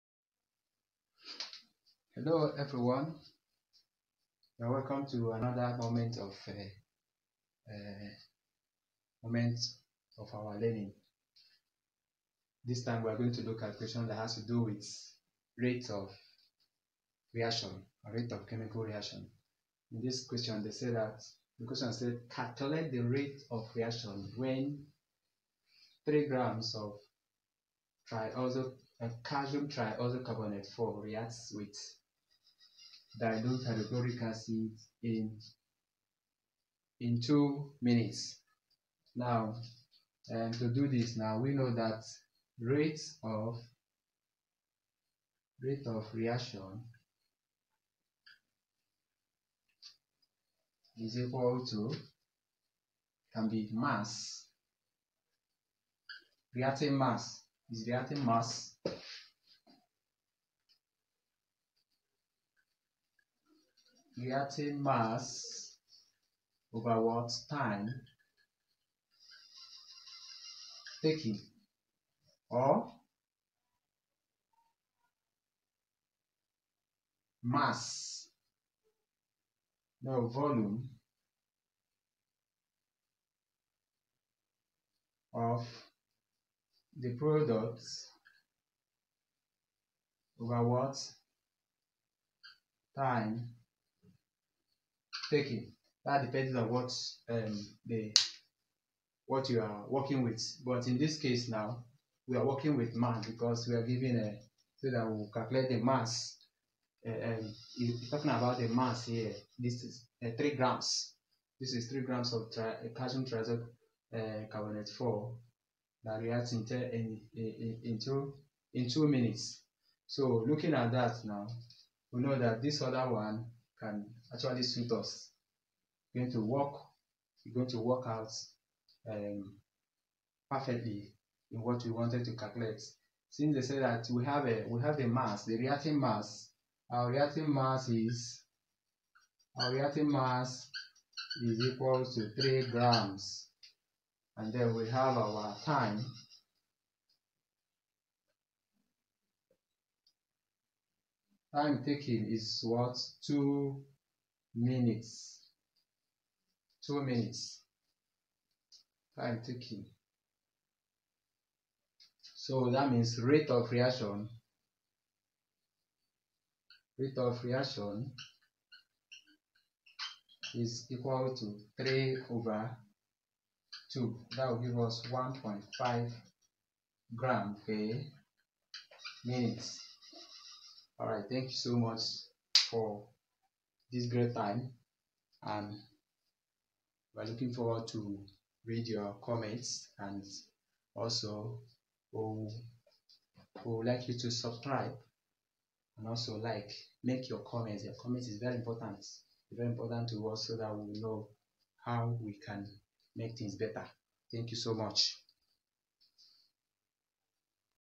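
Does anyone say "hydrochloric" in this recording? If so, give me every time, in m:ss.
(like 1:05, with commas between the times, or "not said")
0:33.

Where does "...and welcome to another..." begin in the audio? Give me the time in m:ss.
0:04.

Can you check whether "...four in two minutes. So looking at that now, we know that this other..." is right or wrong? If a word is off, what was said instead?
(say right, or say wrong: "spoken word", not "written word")
wrong: "two", not "four".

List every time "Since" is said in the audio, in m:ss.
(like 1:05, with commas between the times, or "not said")
2:13.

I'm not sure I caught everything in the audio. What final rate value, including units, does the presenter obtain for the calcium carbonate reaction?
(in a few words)
1.5 grams per minute.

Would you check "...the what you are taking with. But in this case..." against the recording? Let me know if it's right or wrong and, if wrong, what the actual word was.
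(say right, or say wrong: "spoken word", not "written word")
wrong: "working", not "taking".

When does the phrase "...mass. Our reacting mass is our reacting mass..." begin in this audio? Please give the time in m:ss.
2:15.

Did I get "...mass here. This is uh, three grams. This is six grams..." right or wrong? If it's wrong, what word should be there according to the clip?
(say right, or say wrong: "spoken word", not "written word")
wrong: "three", not "six".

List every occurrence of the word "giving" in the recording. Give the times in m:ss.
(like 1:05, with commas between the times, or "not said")
1:43.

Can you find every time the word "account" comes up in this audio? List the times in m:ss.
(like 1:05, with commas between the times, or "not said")
not said.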